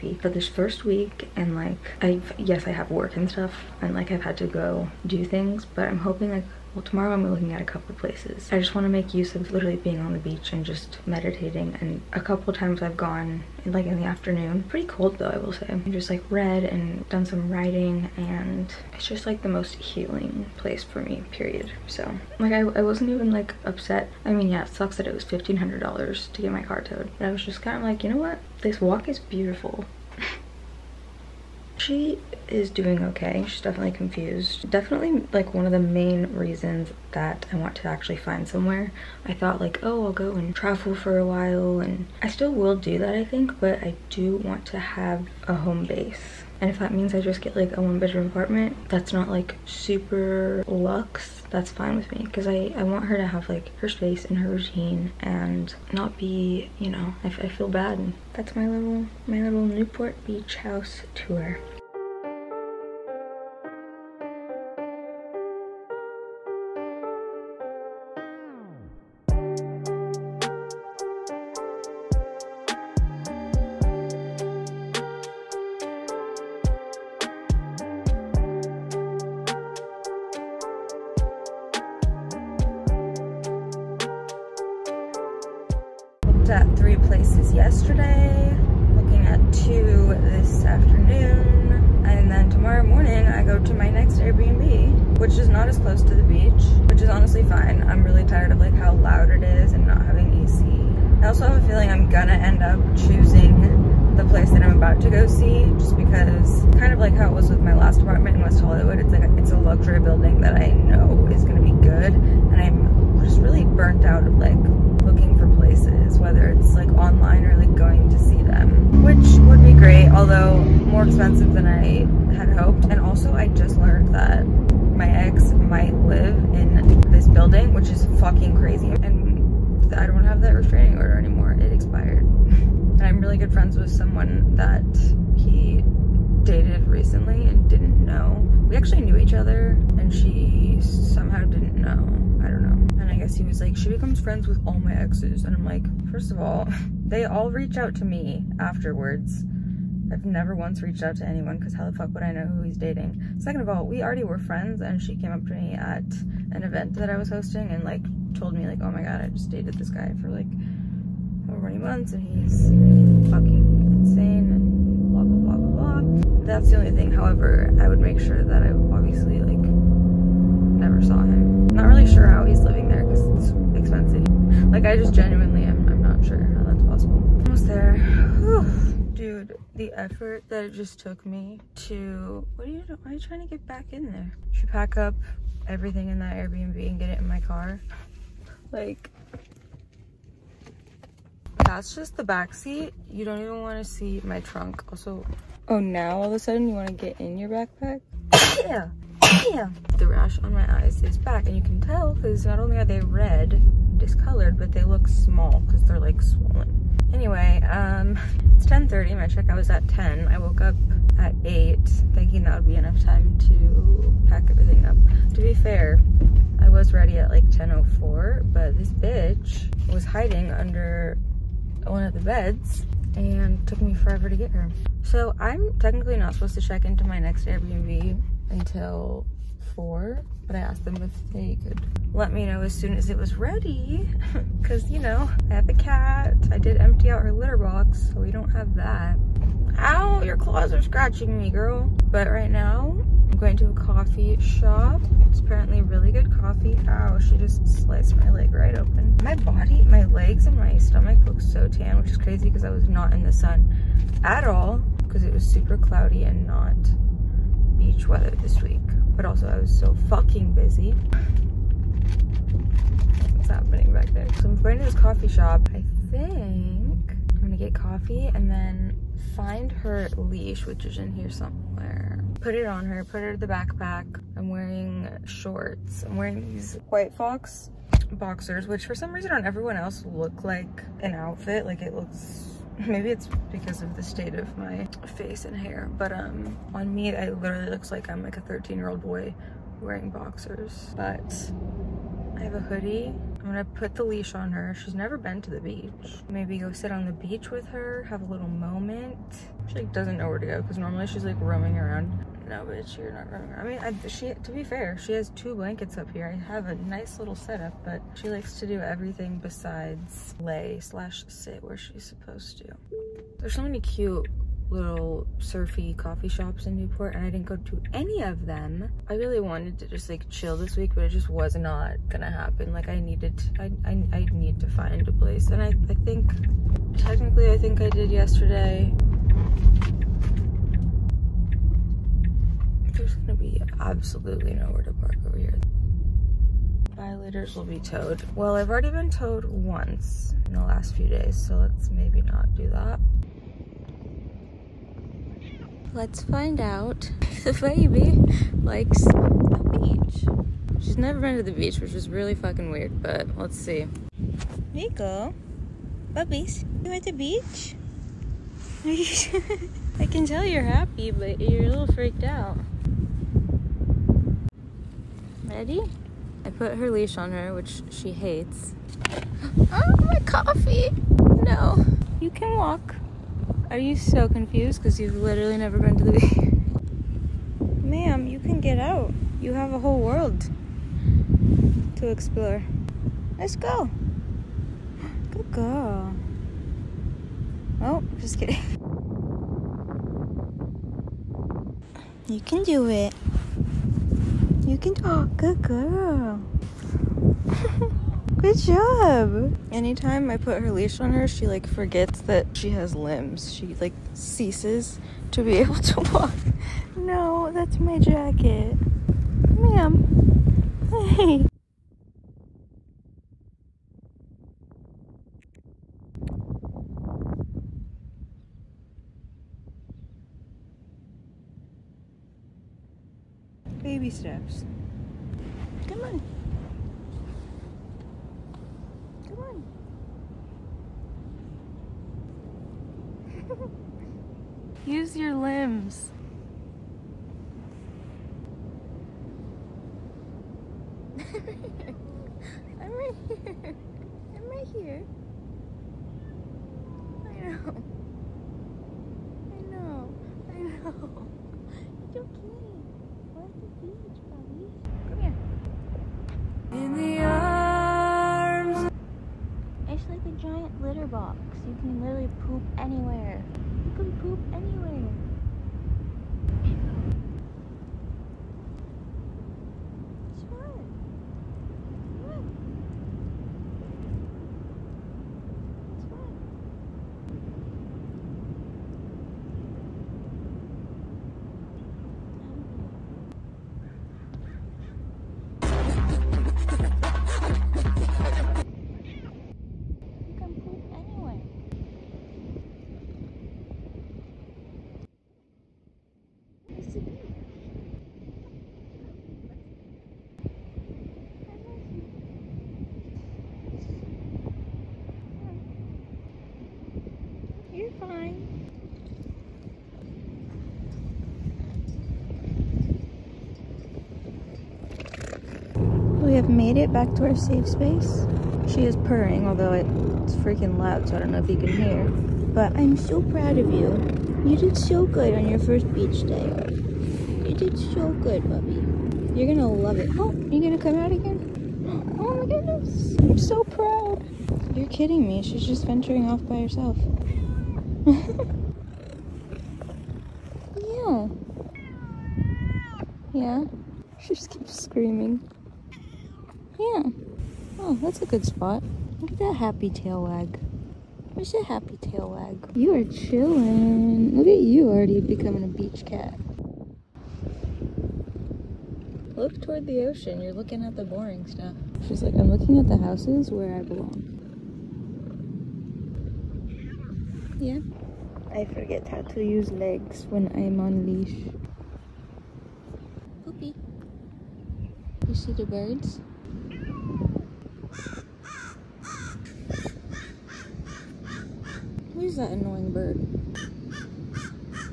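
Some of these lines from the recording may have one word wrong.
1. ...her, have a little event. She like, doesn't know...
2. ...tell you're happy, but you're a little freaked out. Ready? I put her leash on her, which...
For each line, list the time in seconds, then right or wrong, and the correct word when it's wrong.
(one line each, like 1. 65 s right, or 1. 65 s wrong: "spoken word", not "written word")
1. 297 s wrong: "moment", not "event"
2. 360 s right.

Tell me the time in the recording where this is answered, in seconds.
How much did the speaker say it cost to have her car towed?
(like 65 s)
25 s.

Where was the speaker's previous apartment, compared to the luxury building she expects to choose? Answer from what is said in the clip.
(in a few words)
West Hollywood.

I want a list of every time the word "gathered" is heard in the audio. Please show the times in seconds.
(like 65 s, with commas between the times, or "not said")
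not said.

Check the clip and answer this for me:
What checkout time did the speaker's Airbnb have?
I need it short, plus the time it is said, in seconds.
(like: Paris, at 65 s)
10, at 209 s.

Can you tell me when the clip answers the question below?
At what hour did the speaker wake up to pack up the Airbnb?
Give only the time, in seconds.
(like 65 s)
211 s.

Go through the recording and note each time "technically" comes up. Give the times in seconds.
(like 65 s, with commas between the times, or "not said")
225 s, 326 s.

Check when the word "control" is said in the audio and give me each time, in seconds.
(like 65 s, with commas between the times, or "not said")
not said.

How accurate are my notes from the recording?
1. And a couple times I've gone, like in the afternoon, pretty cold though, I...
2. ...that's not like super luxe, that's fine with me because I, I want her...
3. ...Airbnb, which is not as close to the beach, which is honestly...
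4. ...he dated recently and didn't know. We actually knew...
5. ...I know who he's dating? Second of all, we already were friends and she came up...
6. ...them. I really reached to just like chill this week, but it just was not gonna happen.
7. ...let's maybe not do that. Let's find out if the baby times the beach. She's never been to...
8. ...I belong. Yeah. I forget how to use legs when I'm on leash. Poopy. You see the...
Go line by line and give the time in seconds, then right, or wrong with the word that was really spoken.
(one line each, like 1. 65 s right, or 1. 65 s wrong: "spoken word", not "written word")
1. 11 s right
2. 48 s right
3. 94 s right
4. 135 s right
5. 152 s right
6. 318 s wrong: "wanted", not "reached"
7. 341 s wrong: "likes", not "times"
8. 563 s right.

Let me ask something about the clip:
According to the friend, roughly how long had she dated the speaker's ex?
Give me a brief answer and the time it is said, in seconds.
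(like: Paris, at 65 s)
over 20 months, at 161 s.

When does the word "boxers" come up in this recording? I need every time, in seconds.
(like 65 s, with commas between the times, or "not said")
278 s, 290 s.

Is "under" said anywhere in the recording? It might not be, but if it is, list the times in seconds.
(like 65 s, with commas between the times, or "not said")
220 s.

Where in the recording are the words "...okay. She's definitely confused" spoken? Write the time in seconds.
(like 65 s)
33 s.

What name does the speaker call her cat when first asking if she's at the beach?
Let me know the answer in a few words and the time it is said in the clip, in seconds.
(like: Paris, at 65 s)
Nico, at 354 s.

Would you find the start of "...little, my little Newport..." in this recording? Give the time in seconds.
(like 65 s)
58 s.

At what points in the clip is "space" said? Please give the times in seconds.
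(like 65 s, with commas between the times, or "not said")
53 s, 517 s.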